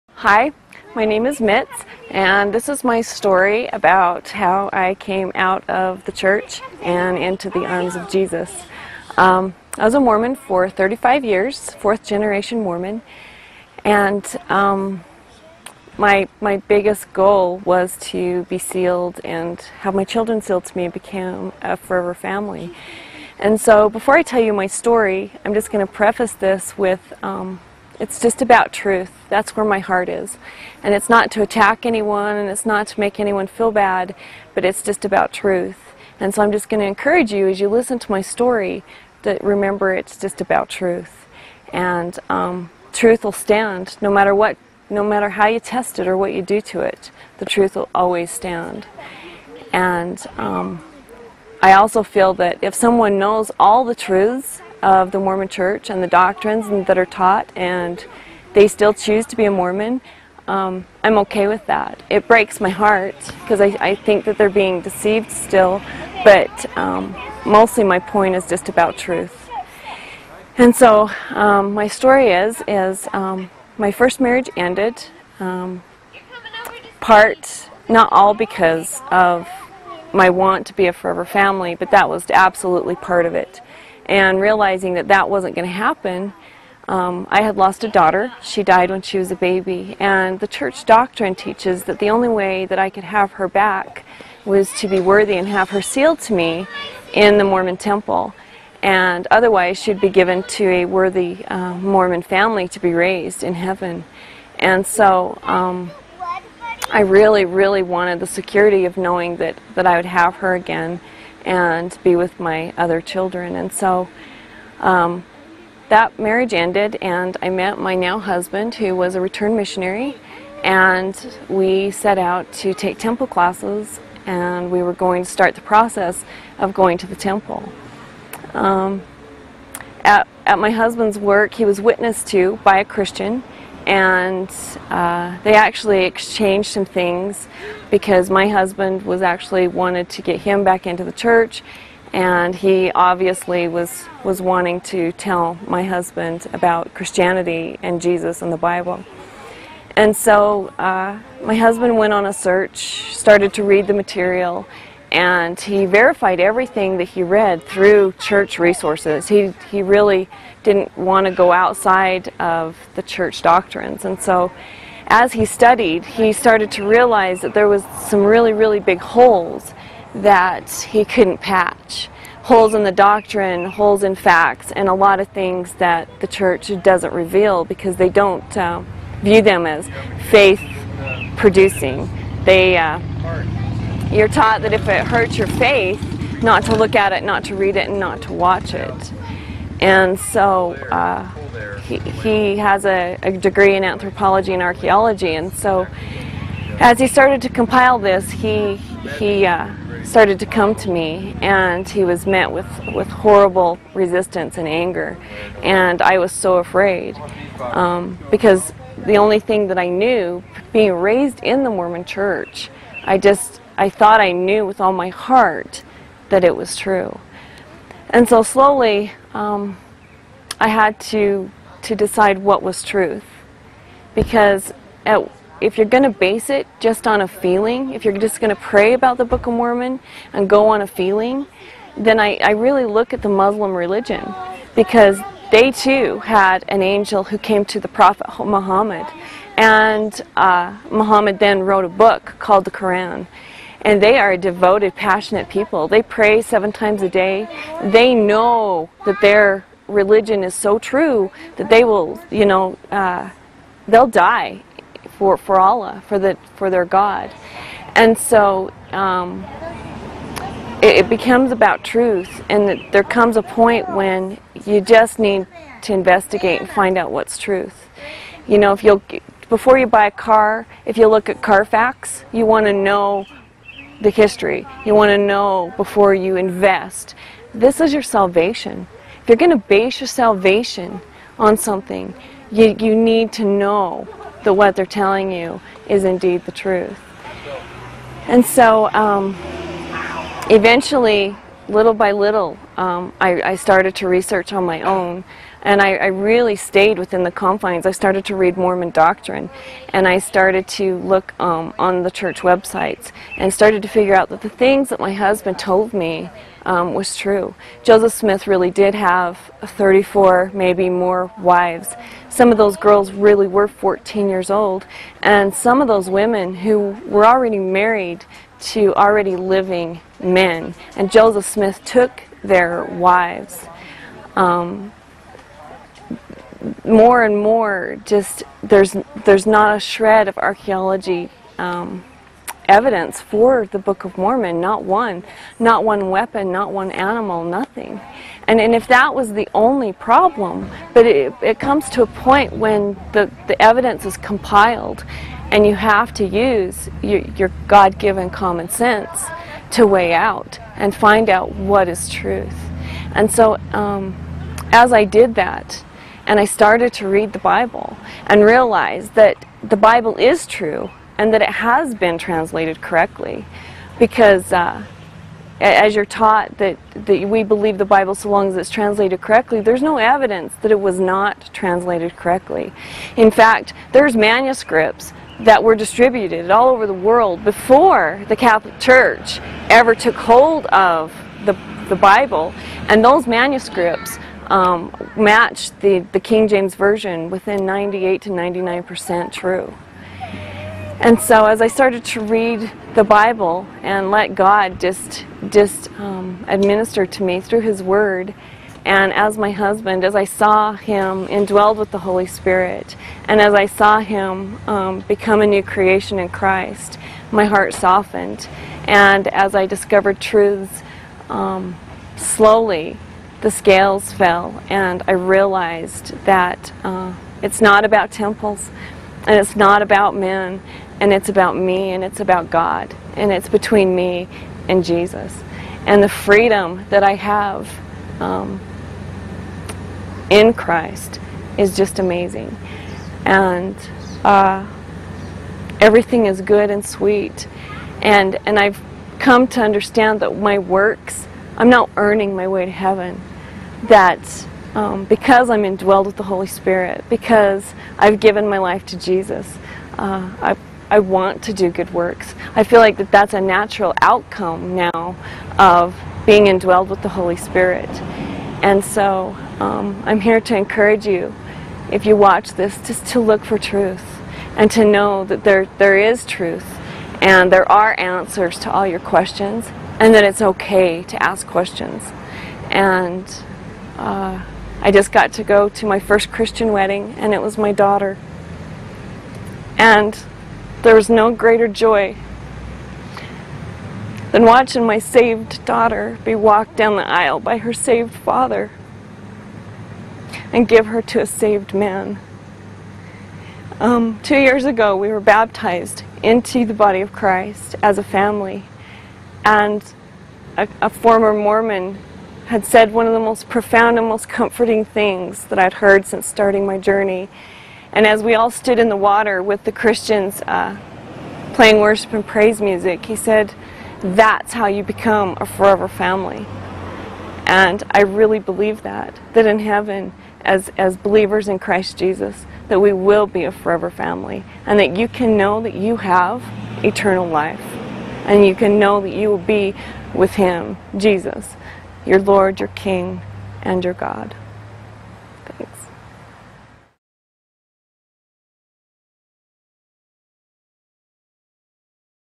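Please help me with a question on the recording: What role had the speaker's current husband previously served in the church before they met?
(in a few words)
Return missionary.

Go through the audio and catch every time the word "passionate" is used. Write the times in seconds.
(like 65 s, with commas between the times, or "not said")
244 s.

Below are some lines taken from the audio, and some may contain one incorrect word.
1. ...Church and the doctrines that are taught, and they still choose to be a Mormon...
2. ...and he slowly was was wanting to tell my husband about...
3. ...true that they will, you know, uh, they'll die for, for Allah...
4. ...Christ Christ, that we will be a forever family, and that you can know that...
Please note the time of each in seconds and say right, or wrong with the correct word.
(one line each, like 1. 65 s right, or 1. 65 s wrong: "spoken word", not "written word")
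1. 55 s right
2. 142 s wrong: "obviously", not "slowly"
3. 250 s right
4. 521 s wrong: "Jesus", not "Christ".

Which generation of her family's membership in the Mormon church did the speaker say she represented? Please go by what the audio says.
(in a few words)
Fourth generation.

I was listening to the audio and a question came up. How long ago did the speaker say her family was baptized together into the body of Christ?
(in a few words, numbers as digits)
Two years.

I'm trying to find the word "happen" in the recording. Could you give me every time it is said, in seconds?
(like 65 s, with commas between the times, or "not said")
85 s.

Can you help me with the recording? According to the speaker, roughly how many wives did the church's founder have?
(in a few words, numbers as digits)
34.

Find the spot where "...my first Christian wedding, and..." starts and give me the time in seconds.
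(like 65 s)
475 s.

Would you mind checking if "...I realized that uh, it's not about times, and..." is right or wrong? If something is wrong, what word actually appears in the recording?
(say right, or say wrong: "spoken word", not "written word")
wrong: "temples", not "times".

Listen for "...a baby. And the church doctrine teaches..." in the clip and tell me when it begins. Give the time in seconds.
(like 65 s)
89 s.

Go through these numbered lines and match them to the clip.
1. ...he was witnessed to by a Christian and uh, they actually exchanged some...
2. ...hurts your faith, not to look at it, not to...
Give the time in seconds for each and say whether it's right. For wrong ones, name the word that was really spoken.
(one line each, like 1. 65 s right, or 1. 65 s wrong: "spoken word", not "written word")
1. 131 s right
2. 185 s right.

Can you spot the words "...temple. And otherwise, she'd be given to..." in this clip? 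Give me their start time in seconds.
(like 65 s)
97 s.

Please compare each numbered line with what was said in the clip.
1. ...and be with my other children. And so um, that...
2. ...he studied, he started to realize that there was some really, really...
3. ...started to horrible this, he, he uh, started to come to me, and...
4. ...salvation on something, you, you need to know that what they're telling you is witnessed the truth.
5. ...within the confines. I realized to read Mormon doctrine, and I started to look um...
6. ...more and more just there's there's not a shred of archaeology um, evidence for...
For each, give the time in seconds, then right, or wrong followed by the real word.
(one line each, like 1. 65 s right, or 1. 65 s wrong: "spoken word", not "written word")
1. 111 s right
2. 165 s right
3. 197 s wrong: "compile", not "horrible"
4. 280 s wrong: "indeed", not "witnessed"
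5. 296 s wrong: "started", not "realized"
6. 326 s right.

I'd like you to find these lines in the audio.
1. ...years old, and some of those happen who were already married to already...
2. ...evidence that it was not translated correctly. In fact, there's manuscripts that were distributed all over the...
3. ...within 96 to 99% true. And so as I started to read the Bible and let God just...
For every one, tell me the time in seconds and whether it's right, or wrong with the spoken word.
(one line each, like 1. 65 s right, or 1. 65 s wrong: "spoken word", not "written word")
1. 314 s wrong: "women", not "happen"
2. 369 s right
3. 387 s wrong: "98", not "96".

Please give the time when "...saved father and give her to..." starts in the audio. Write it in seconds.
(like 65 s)
487 s.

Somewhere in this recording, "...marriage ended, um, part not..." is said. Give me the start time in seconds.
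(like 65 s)
74 s.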